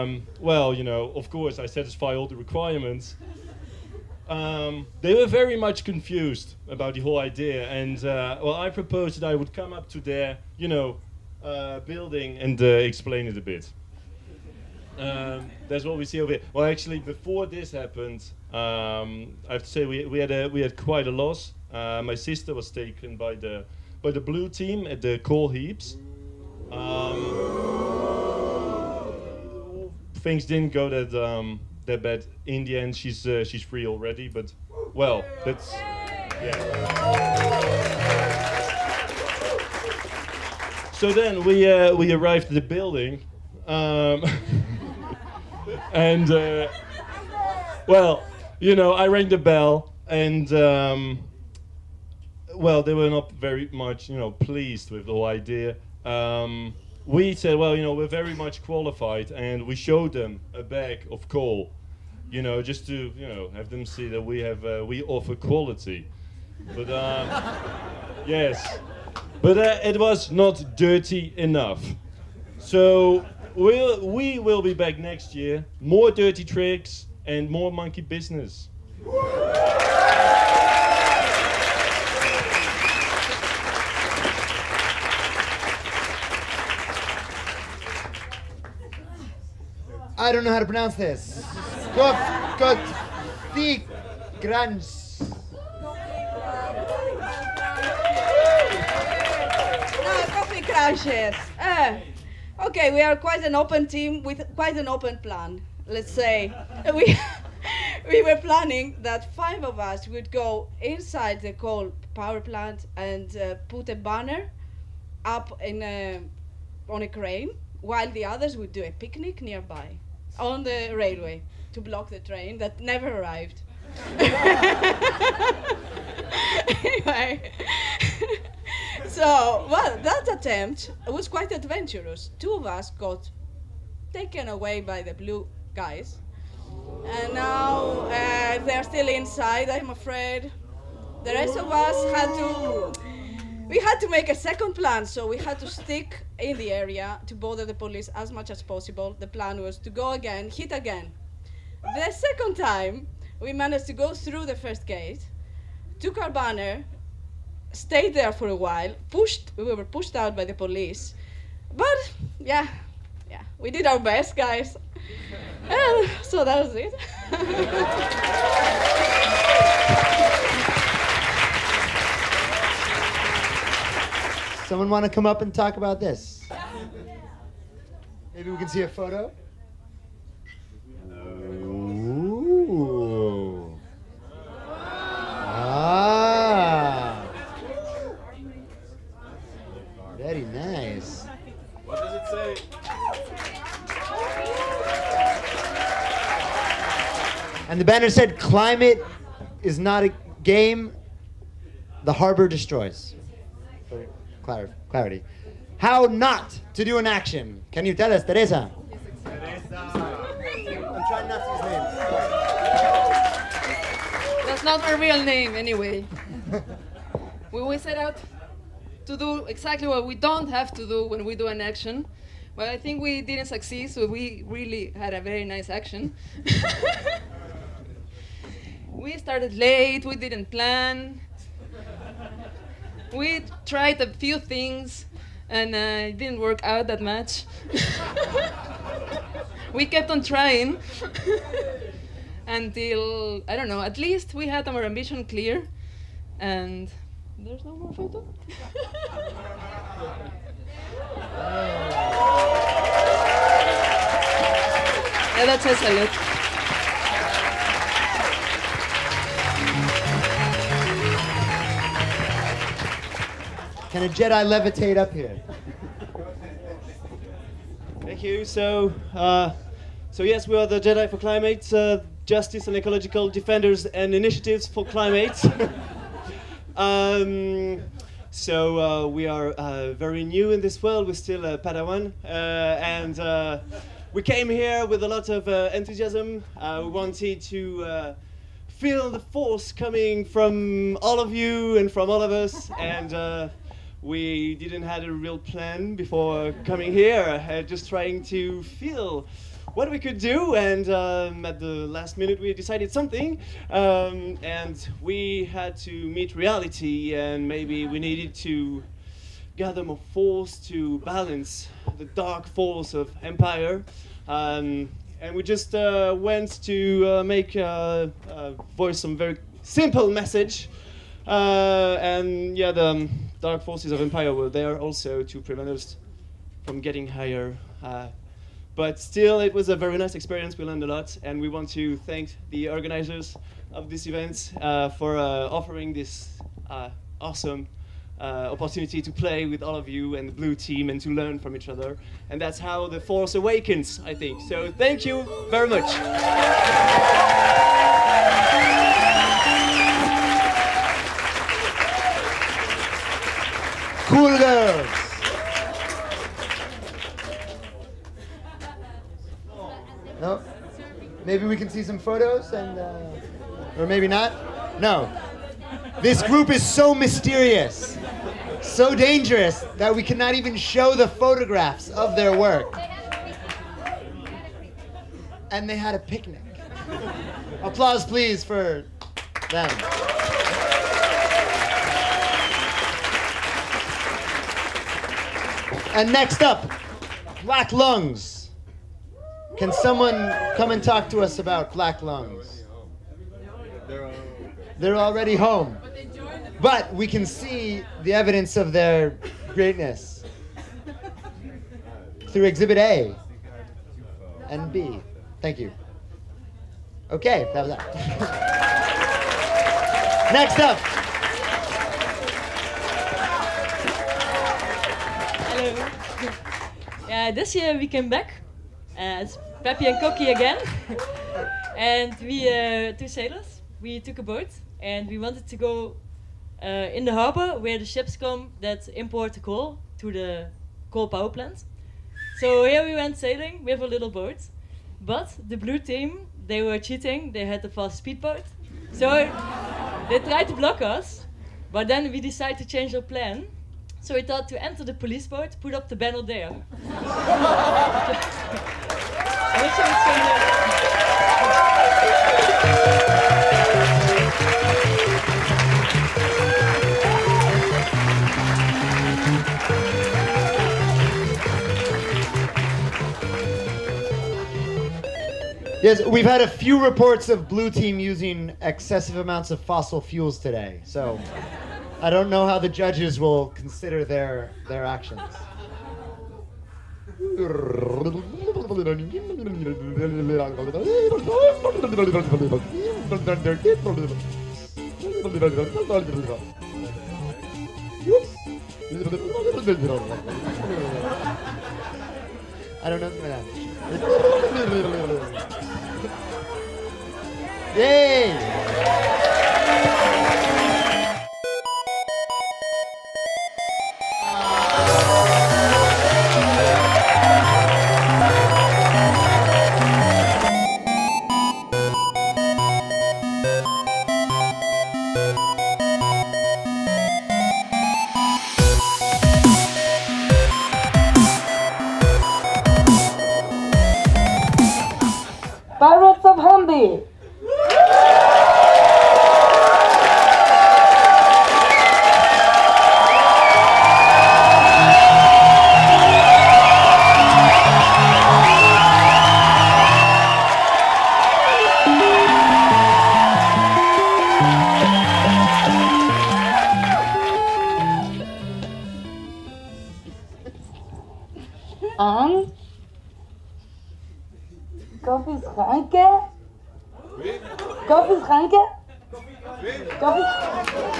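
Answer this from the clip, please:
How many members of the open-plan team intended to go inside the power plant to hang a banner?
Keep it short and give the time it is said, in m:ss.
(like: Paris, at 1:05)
5, at 1:49.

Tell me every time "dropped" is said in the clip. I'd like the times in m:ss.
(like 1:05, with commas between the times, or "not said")
not said.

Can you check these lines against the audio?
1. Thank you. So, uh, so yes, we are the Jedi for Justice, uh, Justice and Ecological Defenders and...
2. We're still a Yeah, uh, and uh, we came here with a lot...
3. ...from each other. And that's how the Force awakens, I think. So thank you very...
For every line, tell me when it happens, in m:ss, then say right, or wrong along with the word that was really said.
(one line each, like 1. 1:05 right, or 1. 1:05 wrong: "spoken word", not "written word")
1. 4:28 wrong: "Climate", not "Justice"
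2. 4:41 wrong: "Padawan", not "Yeah"
3. 5:41 right.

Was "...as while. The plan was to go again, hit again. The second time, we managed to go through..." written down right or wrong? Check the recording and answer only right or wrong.
wrong.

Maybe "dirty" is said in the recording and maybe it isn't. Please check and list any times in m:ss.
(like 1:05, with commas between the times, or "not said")
1:10, 1:16.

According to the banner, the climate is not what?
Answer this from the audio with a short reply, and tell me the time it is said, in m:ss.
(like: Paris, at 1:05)
A game, at 3:20.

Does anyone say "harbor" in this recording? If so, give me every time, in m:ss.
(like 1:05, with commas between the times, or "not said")
3:22, 7:07.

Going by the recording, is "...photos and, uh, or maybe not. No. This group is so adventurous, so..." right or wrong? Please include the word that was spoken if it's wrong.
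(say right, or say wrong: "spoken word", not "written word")
wrong: "mysterious", not "adventurous".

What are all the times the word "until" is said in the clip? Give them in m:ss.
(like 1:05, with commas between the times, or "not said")
4:02.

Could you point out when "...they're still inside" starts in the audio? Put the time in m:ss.
2:18.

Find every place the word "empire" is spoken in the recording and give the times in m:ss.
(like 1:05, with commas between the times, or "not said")
5:13, 5:23.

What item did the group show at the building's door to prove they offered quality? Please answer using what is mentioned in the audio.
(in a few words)
A bag of coal.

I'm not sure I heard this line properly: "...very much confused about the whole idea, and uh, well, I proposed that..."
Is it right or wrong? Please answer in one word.
right.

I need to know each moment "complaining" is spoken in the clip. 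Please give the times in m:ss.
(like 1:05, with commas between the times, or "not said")
not said.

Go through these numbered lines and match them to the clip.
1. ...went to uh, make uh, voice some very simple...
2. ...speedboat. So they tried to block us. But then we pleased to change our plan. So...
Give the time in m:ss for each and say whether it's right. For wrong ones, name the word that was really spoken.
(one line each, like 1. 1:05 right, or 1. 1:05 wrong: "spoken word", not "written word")
1. 5:16 right
2. 7:17 wrong: "decided", not "pleased".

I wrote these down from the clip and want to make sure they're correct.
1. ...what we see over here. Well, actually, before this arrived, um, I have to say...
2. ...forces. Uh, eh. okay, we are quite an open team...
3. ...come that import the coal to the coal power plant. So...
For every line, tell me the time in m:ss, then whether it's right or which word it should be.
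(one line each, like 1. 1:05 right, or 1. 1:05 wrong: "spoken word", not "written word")
1. 0:15 wrong: "happened", not "arrived"
2. 1:40 wrong: "crunches", not "forces"
3. 7:08 right.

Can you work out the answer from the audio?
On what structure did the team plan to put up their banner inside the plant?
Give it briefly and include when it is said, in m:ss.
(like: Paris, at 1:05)
A crane, at 1:57.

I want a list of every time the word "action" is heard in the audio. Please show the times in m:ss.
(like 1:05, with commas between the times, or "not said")
3:27, 3:41, 3:45, 7:54.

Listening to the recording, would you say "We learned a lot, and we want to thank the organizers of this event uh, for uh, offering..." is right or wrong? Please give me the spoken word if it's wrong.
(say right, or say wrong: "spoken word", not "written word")
right.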